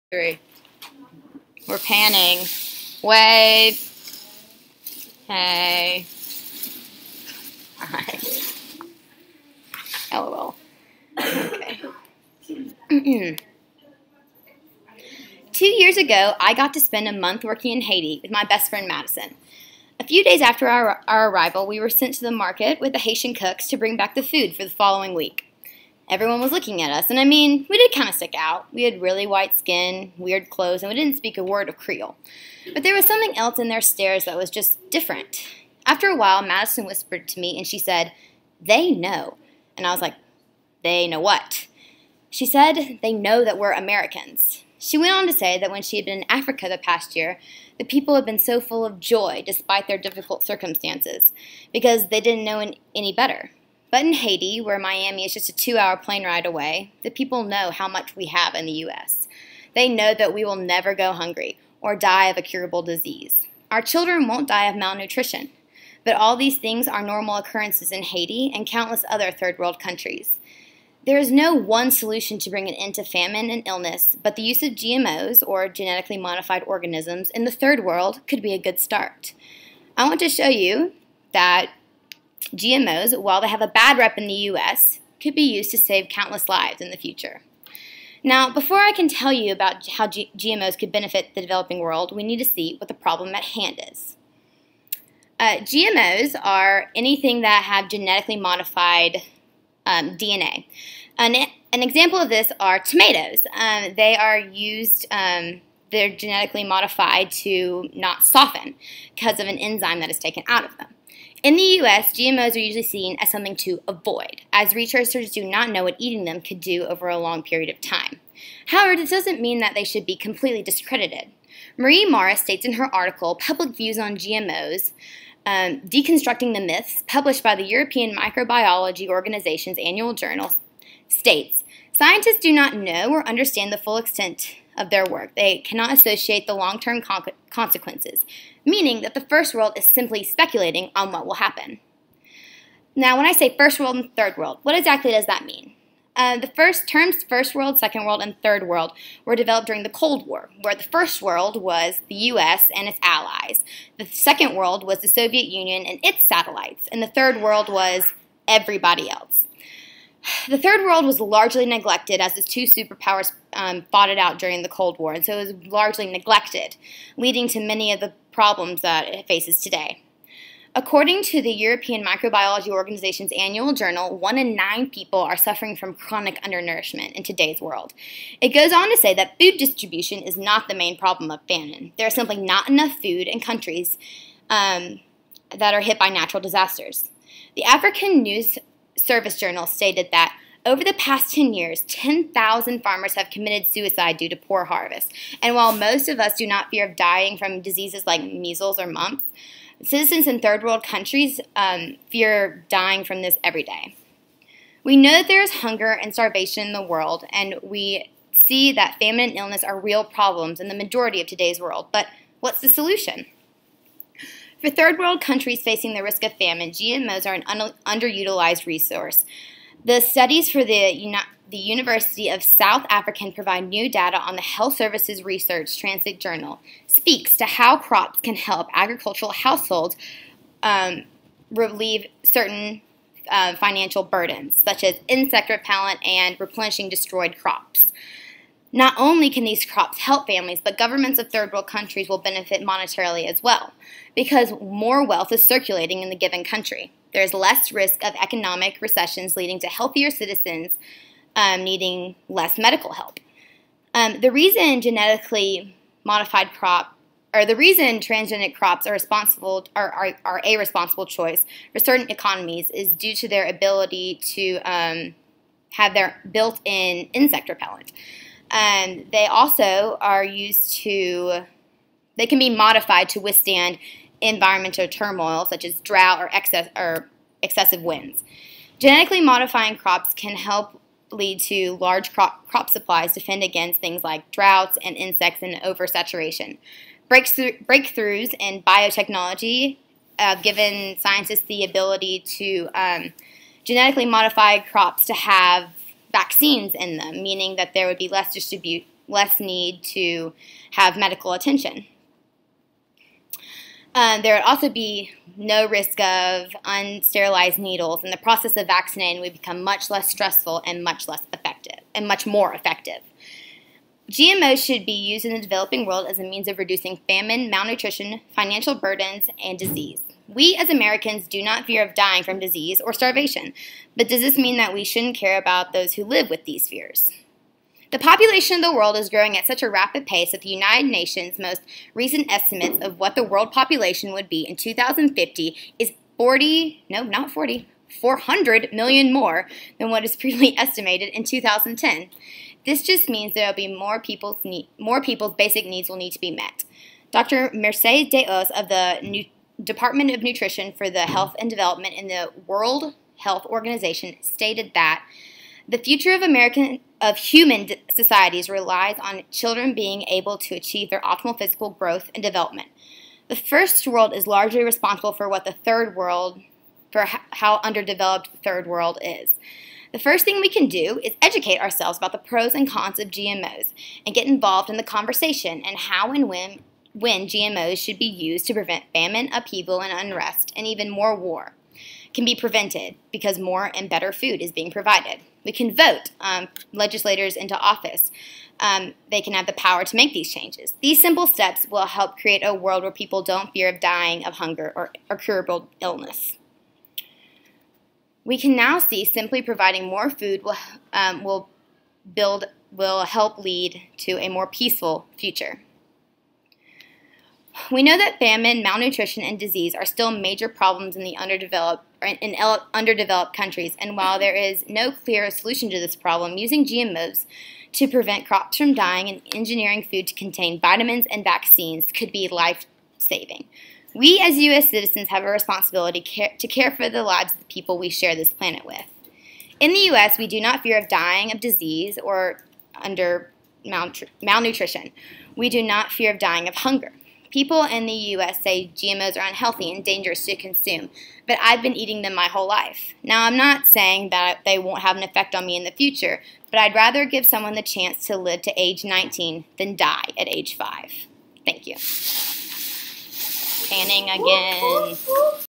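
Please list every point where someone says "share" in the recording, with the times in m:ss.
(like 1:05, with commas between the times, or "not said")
7:07.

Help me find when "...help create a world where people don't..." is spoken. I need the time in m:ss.
6:31.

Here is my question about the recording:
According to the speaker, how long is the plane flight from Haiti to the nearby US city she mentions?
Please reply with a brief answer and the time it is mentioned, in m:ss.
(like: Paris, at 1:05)
2 hours, at 0:55.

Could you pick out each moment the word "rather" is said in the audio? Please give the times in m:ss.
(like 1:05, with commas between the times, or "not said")
7:26.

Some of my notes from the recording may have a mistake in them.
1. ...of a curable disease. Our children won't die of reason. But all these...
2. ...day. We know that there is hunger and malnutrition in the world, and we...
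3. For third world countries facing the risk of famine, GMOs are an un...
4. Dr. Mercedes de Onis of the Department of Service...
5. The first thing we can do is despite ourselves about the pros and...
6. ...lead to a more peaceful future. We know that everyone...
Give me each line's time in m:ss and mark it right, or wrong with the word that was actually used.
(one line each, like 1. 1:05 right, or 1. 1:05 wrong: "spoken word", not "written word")
1. 1:02 wrong: "malnutrition", not "reason"
2. 3:23 wrong: "starvation", not "malnutrition"
3. 3:34 right
4. 5:47 wrong: "Nutrition", not "Service"
5. 6:09 wrong: "educate", not "despite"
6. 6:43 wrong: "famine", not "everyone".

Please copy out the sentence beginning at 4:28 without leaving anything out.
Um, they also are used to, they can be modified to withstand environmental turmoil such as drought or, excess, or excessive winds.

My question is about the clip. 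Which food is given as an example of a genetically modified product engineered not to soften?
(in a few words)
Tomatoes.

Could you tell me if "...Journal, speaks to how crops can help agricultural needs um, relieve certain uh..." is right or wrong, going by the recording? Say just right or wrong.
wrong.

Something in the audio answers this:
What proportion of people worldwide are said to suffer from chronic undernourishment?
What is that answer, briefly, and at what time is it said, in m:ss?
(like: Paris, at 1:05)
1 in 9, at 2:54.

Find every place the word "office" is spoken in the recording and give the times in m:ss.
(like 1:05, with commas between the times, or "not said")
6:27.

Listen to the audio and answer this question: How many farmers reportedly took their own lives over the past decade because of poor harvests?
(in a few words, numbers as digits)
10,000.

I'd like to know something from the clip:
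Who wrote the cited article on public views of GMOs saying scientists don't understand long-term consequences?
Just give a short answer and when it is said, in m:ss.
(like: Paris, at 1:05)
Marie Morris, at 2:01.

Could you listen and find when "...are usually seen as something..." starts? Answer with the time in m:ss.
1:52.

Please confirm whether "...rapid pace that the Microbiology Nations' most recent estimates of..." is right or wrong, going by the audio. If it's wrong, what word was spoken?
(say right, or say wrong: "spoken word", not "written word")
wrong: "United", not "Microbiology".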